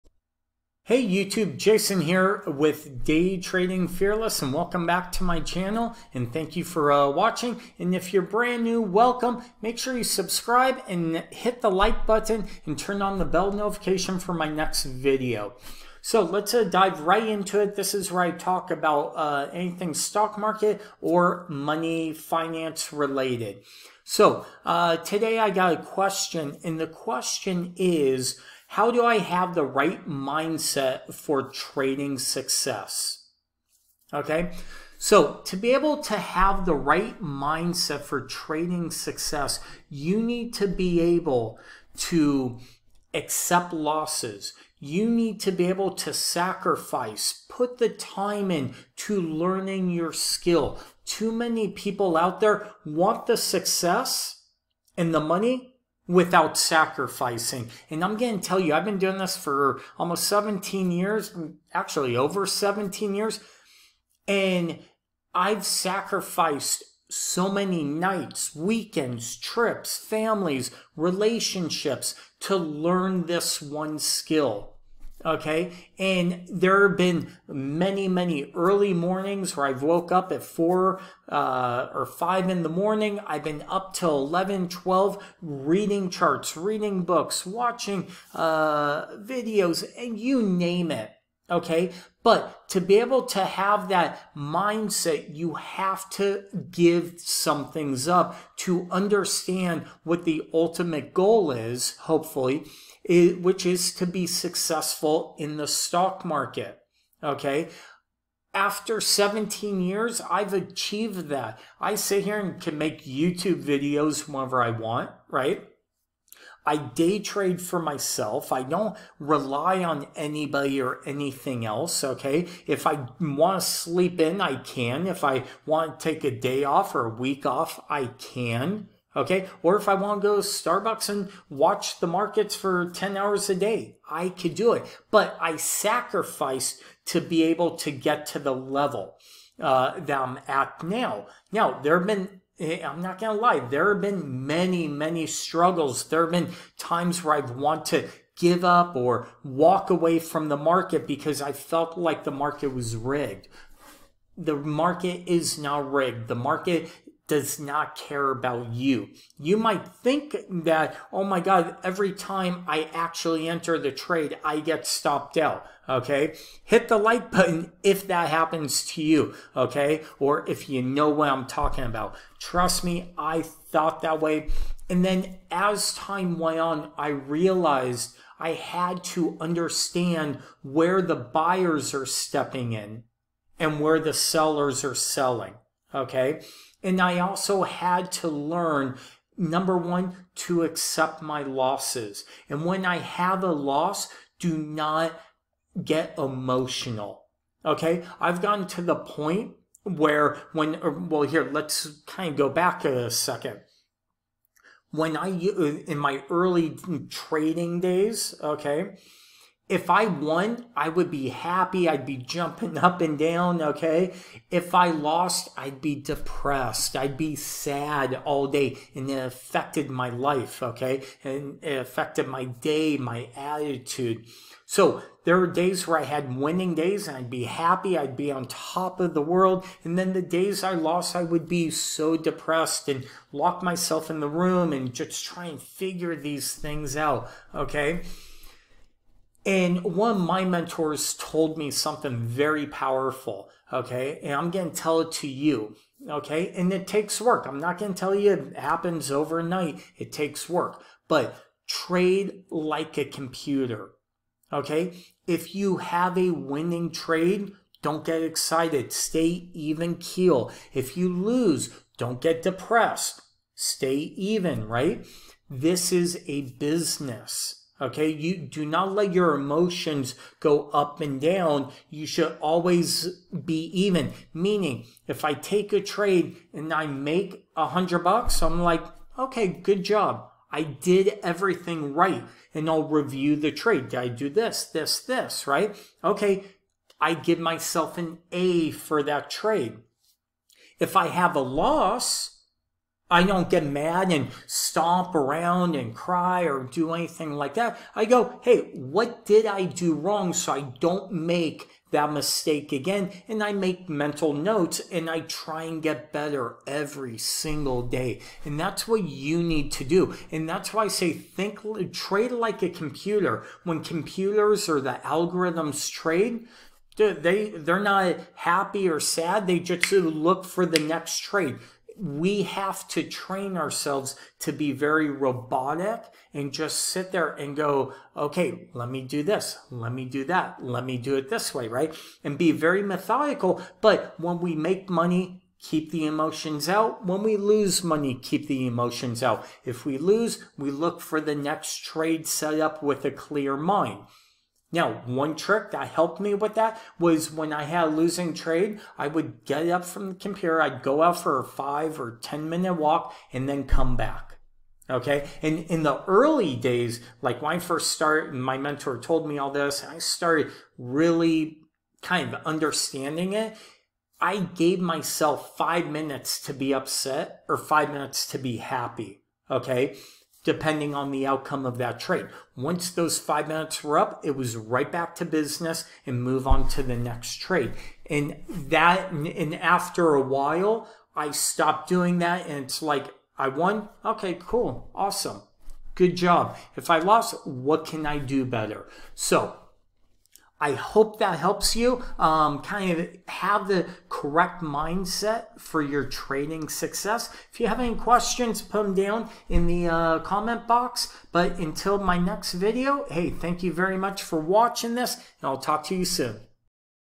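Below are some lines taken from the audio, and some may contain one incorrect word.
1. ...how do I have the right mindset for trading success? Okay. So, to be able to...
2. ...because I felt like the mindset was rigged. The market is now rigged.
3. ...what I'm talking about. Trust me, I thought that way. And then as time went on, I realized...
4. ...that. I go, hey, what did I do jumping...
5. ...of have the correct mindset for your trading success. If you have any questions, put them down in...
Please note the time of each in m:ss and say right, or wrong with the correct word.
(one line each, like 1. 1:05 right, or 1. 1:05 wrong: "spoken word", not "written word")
1. 0:28 right
2. 2:31 wrong: "market", not "mindset"
3. 2:51 right
4. 4:57 wrong: "wrong", not "jumping"
5. 6:32 right.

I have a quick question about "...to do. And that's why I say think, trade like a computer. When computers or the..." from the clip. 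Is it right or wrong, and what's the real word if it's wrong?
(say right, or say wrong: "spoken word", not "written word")
right.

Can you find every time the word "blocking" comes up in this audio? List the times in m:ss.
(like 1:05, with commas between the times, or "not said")
not said.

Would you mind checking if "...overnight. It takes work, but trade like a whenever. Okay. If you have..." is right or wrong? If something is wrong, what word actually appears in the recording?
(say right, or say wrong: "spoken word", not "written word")
wrong: "computer", not "whenever".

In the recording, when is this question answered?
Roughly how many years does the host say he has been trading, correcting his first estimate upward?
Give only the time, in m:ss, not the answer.
1:01.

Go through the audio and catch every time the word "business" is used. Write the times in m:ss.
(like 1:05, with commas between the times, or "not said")
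4:26, 6:15.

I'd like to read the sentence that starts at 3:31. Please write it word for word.
I'd be jumping up and down, okay?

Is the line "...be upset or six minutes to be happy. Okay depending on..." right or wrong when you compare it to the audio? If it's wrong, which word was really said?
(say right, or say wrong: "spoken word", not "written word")
wrong: "five", not "six".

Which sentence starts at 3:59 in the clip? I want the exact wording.
And one of my mentors told me something very powerful.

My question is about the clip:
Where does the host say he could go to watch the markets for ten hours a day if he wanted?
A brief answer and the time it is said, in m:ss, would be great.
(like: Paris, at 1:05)
Starbucks, at 2:10.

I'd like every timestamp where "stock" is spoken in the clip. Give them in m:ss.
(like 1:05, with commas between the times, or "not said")
0:19, 1:45.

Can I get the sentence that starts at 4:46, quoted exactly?
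Okay, I give myself an A for that trade.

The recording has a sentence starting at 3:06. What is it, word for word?
And I also had to learn number one, to accept my losses.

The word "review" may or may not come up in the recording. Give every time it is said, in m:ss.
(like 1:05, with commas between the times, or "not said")
4:42.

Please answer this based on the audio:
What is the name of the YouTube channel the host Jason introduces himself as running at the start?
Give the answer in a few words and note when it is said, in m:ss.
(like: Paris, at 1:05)
Day Trading Fearless, at 0:03.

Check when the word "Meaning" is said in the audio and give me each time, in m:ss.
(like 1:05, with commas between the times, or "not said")
4:34.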